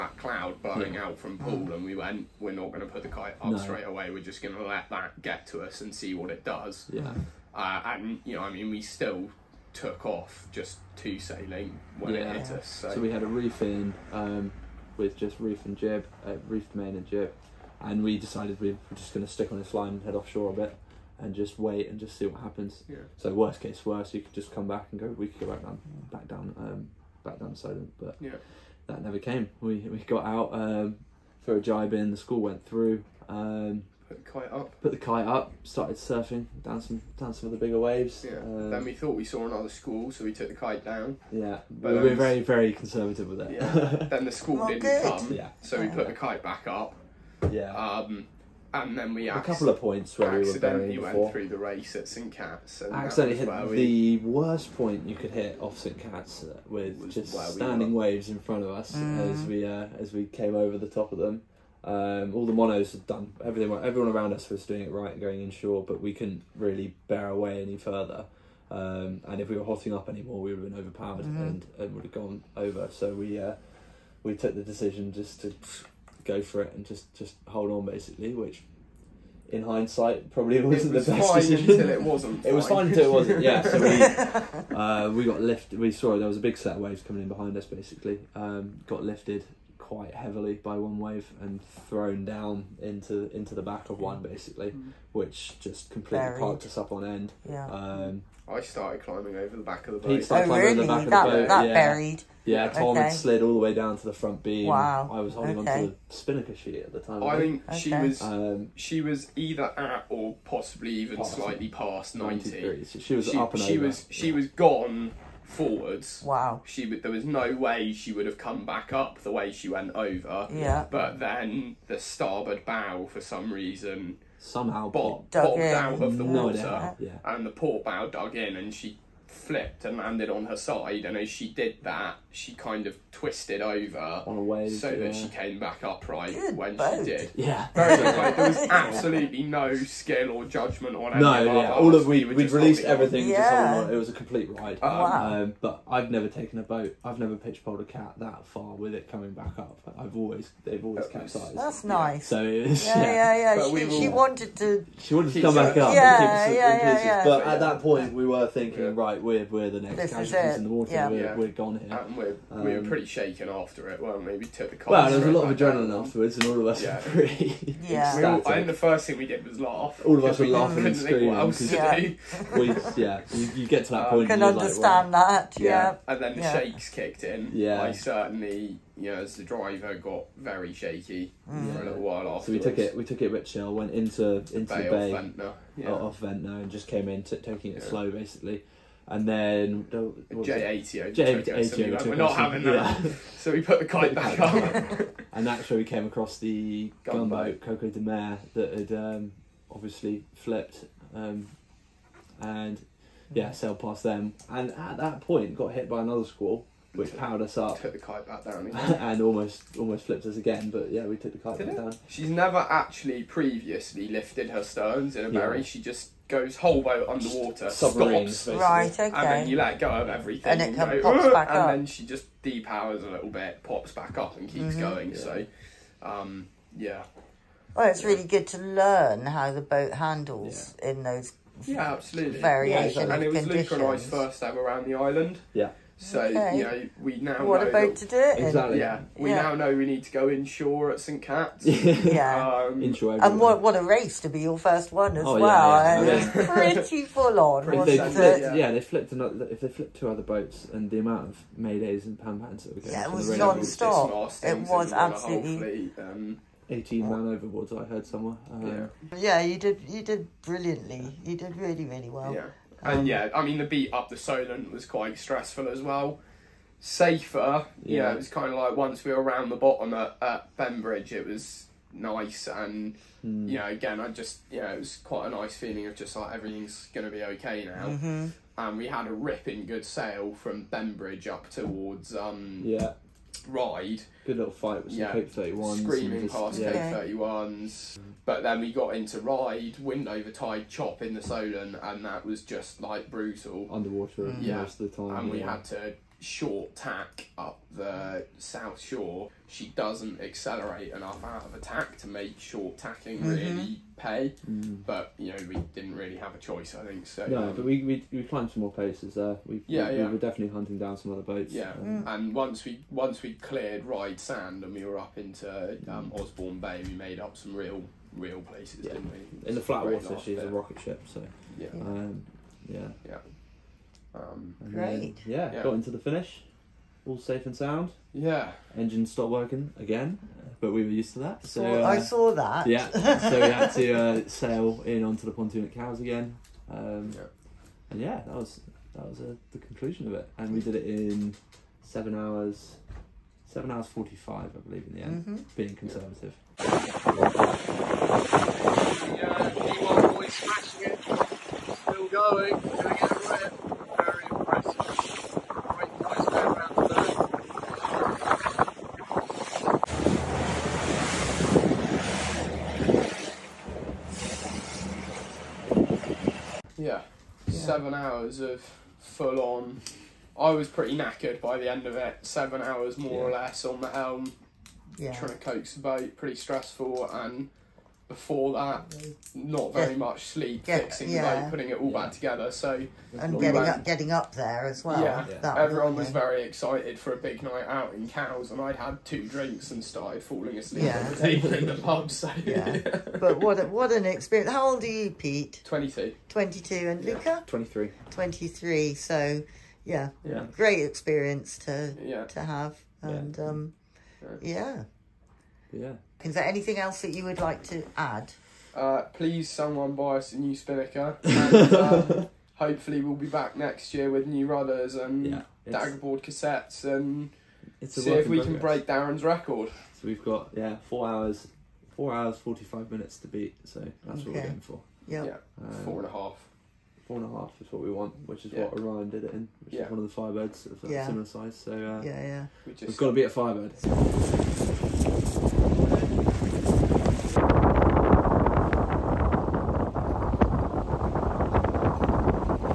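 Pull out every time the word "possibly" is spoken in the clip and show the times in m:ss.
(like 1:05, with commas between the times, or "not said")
1:50.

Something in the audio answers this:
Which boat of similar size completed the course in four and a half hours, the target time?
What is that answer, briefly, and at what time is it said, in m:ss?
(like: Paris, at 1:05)
Orion, at 7:08.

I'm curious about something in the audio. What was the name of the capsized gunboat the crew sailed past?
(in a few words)
Coco de Mer.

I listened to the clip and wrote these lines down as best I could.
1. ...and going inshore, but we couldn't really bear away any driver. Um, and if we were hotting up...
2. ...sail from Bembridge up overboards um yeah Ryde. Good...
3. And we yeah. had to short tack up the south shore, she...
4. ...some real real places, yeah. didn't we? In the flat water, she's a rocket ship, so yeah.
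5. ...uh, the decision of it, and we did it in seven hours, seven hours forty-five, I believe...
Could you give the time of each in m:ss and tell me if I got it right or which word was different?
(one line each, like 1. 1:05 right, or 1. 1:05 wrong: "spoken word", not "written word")
1. 1:05 wrong: "further", not "driver"
2. 4:39 wrong: "towards", not "overboards"
3. 4:55 right
4. 5:17 right
5. 5:39 wrong: "conclusion", not "decision".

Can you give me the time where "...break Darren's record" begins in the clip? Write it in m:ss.
6:58.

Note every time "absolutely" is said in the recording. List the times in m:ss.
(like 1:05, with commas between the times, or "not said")
2:18, 3:51, 4:14.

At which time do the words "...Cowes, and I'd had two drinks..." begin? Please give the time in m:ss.
6:28.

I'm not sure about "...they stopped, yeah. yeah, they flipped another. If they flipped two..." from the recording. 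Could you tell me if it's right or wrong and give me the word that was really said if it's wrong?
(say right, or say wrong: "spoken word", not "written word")
wrong: "flipped", not "stopped".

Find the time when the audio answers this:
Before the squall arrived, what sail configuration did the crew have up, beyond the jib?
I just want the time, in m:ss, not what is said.
0:16.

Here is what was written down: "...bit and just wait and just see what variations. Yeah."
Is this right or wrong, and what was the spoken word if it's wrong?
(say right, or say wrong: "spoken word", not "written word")
wrong: "happens", not "variations".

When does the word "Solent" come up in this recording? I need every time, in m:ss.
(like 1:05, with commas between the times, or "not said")
4:24, 4:51.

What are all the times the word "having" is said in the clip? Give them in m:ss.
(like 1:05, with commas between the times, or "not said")
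3:12.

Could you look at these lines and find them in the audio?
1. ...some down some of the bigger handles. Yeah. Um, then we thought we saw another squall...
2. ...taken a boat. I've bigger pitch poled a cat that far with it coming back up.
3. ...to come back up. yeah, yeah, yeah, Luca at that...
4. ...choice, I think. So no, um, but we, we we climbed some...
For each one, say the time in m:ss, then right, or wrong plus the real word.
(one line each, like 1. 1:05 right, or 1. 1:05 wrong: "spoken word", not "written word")
1. 0:36 wrong: "waves", not "handles"
2. 2:26 wrong: "never", not "bigger"
3. 2:35 wrong: "But", not "Luca"
4. 5:06 right.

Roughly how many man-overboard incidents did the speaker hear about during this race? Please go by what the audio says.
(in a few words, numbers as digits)
18.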